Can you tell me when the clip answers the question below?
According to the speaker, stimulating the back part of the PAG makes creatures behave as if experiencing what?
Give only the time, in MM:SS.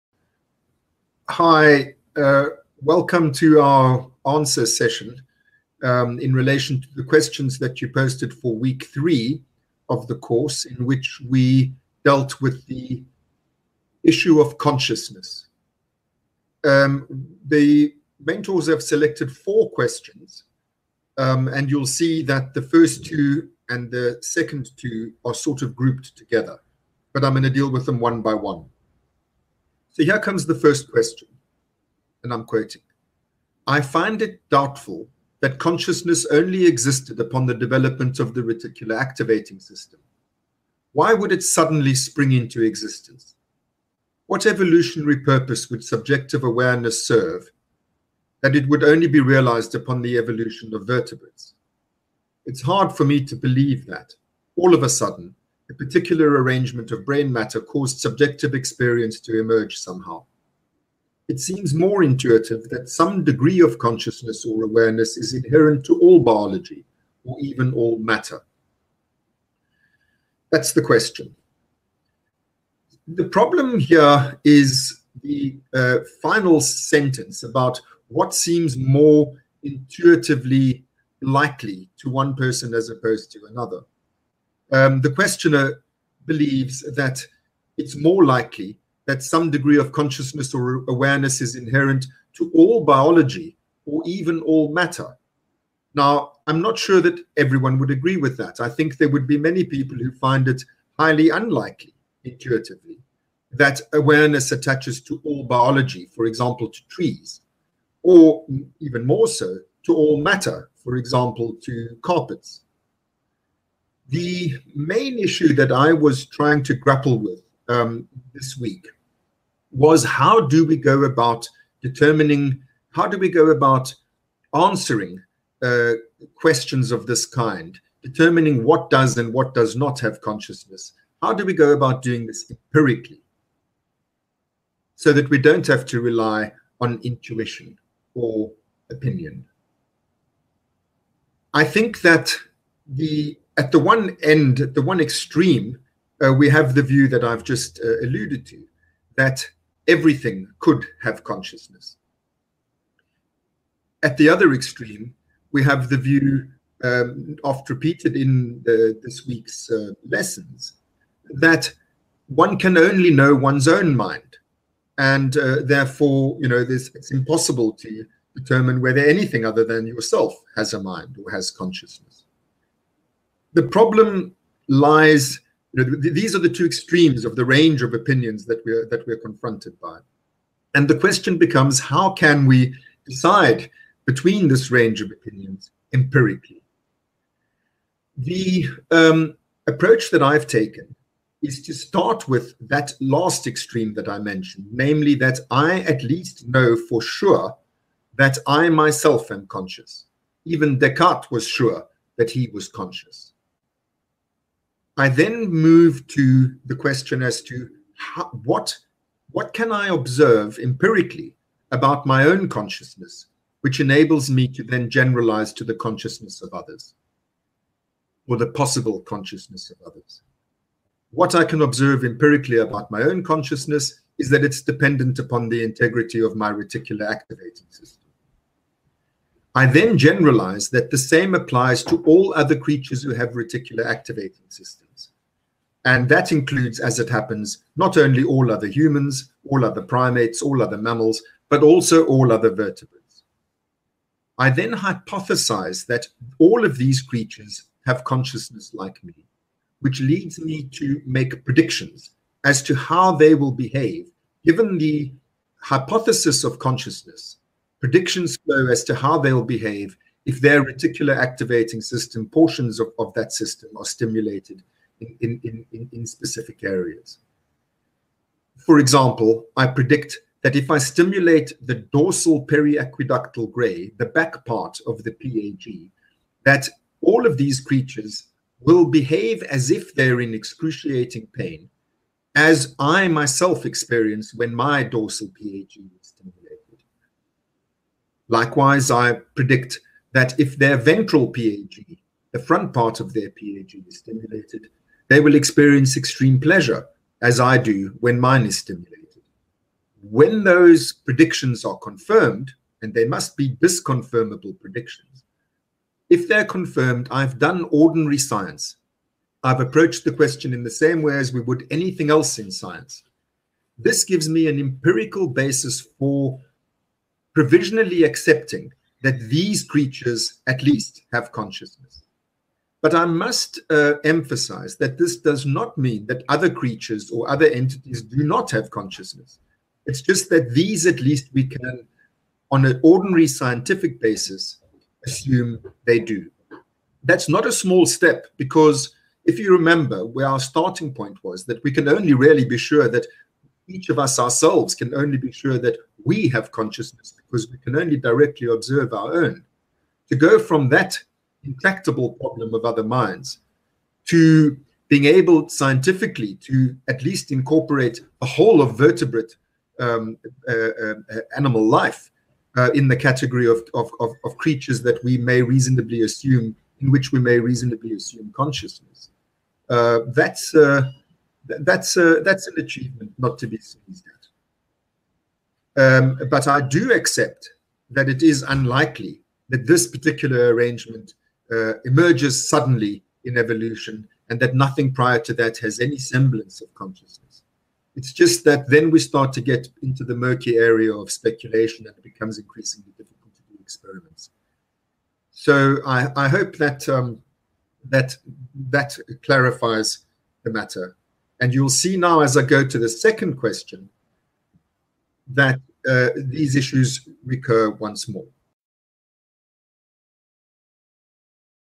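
04:40.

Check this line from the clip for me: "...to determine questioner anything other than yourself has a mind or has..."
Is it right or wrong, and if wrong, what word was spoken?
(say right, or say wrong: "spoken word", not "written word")
wrong: "whether", not "questioner".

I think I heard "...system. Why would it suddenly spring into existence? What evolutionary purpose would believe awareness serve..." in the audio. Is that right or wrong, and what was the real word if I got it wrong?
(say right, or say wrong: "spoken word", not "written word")
wrong: "subjective", not "believe".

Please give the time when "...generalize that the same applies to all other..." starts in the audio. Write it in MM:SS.
03:49.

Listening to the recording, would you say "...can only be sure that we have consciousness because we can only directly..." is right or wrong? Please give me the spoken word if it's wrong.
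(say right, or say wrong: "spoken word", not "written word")
right.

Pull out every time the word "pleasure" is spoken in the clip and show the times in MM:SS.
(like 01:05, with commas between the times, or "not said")
04:56.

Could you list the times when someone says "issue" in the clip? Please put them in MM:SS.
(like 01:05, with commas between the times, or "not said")
00:14, 01:55, 06:46.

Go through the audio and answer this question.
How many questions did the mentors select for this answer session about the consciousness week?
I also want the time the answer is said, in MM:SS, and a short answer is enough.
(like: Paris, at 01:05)
4, at 00:19.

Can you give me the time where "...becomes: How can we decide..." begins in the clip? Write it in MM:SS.
03:01.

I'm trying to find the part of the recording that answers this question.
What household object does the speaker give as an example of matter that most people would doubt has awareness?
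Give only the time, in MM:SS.
01:52.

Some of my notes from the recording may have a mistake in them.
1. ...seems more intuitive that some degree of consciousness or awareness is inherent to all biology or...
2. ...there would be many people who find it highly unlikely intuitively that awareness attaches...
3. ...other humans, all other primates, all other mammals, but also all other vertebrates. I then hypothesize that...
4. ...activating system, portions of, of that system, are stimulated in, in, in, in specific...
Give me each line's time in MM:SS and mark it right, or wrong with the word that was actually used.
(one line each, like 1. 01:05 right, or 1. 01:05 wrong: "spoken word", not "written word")
1. 01:01 right
2. 01:38 right
3. 03:58 right
4. 04:21 right.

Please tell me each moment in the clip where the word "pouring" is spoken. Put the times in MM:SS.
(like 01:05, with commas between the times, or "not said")
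not said.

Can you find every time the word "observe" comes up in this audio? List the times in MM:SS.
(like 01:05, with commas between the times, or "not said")
03:29, 03:41, 05:48.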